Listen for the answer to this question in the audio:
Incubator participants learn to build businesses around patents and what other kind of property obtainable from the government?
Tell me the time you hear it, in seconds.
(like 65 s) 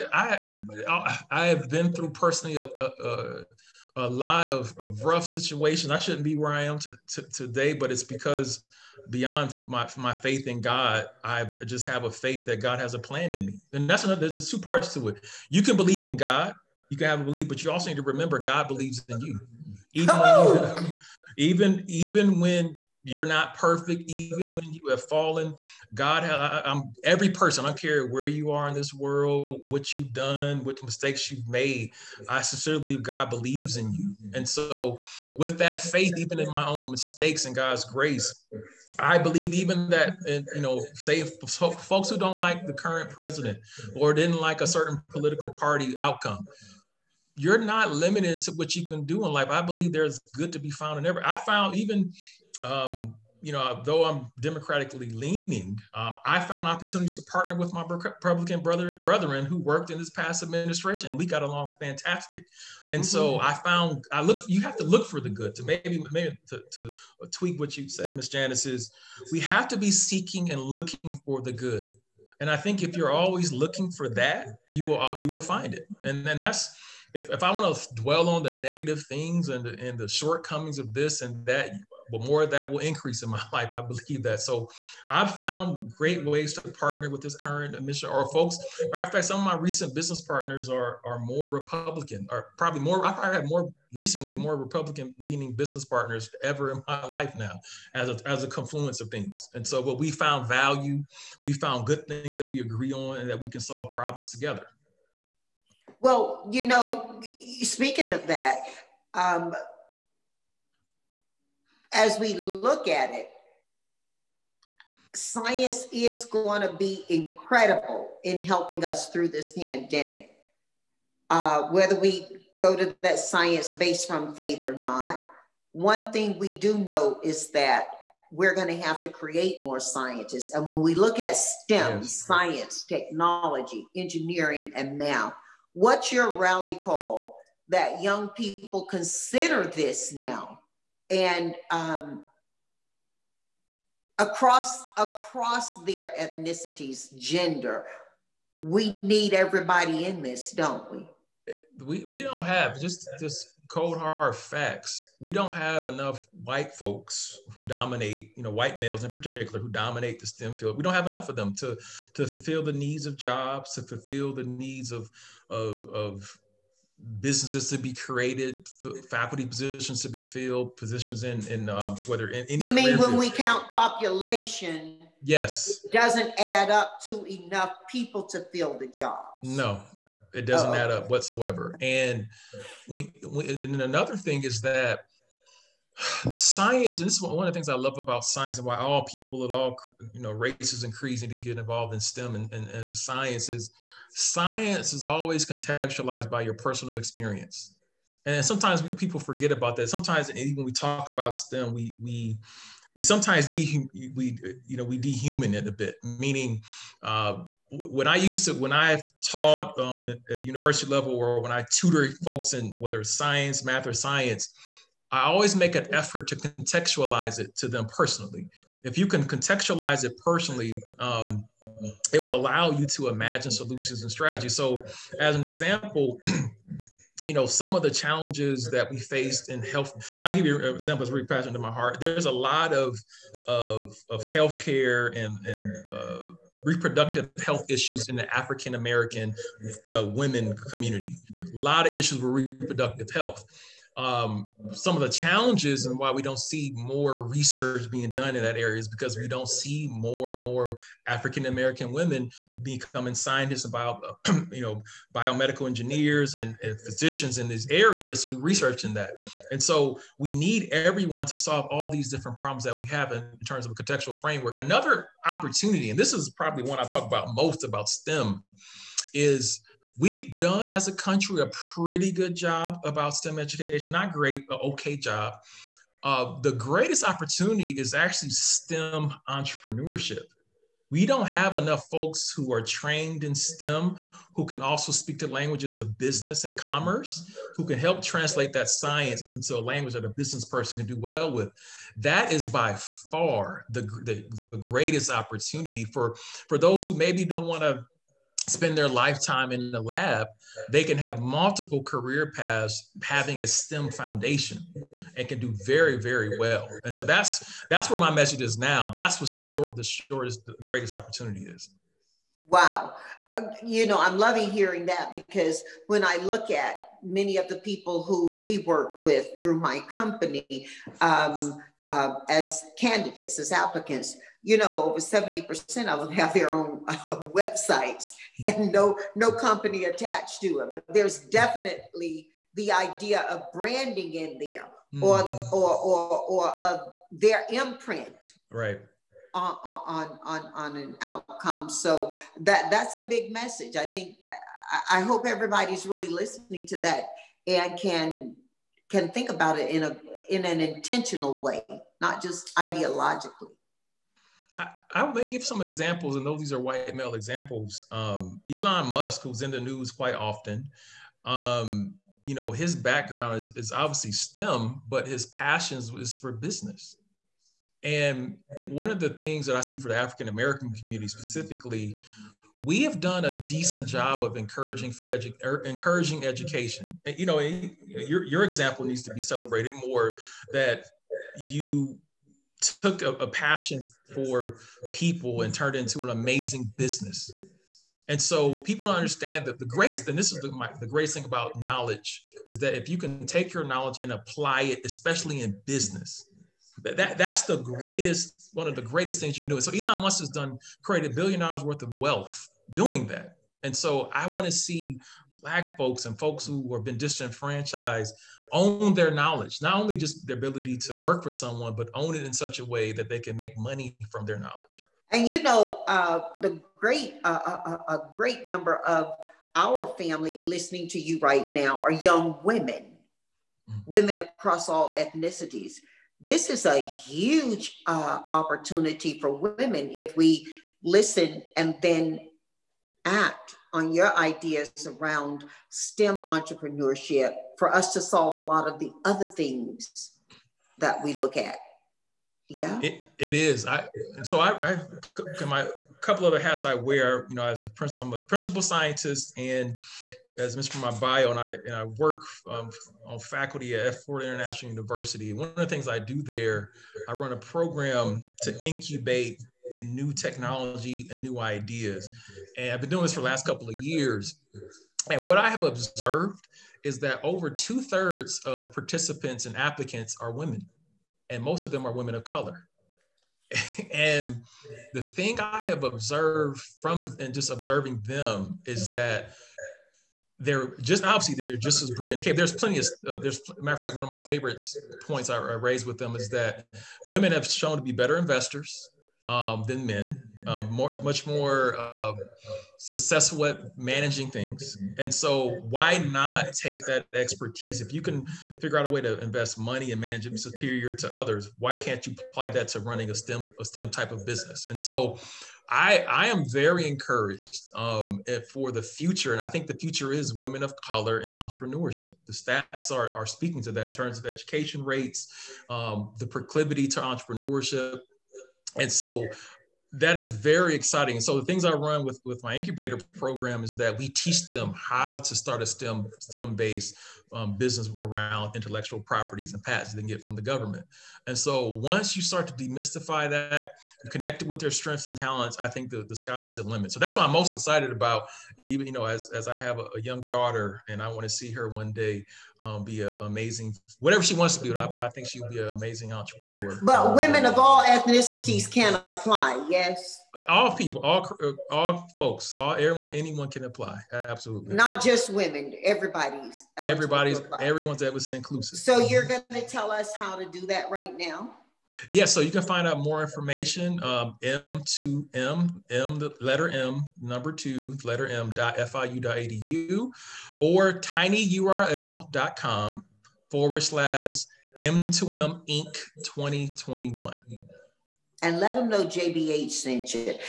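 528 s.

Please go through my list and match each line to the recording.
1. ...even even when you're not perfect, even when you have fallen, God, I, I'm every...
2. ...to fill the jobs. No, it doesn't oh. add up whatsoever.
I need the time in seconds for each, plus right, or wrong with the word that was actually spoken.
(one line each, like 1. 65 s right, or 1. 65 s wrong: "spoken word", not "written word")
1. 21 s right
2. 178 s right.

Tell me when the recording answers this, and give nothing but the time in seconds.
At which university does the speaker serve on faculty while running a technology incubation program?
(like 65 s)
454 s.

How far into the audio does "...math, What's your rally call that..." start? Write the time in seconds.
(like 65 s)
134 s.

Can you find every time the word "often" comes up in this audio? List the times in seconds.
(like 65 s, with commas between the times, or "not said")
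360 s.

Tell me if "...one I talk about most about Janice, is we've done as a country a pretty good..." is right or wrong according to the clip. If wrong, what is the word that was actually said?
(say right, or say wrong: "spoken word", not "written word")
wrong: "STEM", not "Janice".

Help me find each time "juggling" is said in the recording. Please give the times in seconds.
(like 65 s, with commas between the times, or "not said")
not said.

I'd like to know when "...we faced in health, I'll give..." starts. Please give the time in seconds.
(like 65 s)
228 s.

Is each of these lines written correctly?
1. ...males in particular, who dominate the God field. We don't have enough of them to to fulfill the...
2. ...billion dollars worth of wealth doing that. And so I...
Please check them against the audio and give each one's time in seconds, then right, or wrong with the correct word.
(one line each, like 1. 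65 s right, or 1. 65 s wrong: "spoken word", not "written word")
1. 158 s wrong: "STEM", not "God"
2. 401 s right.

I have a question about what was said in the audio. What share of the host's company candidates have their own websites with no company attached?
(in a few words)
Over 70%.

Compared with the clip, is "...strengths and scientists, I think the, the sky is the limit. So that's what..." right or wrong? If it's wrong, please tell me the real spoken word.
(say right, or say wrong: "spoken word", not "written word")
wrong: "talents", not "scientists".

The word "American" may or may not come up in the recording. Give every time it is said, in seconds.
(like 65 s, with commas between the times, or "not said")
238 s, 251 s, 370 s.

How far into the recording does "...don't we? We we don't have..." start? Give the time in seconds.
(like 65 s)
150 s.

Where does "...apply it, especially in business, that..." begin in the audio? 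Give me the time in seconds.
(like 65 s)
394 s.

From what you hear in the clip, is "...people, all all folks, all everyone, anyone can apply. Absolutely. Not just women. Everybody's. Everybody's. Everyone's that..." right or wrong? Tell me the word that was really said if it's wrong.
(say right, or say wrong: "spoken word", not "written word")
right.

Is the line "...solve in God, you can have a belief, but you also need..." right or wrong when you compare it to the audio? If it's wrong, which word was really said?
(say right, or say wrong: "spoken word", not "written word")
wrong: "believe", not "solve".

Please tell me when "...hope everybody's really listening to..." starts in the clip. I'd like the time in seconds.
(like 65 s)
345 s.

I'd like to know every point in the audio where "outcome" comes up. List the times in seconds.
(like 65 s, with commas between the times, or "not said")
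45 s, 341 s.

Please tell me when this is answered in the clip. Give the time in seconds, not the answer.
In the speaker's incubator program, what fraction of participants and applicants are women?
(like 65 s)
467 s.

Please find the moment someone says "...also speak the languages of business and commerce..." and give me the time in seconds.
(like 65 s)
284 s.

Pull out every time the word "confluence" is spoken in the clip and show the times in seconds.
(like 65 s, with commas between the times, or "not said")
98 s.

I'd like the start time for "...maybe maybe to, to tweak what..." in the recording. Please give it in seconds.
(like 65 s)
65 s.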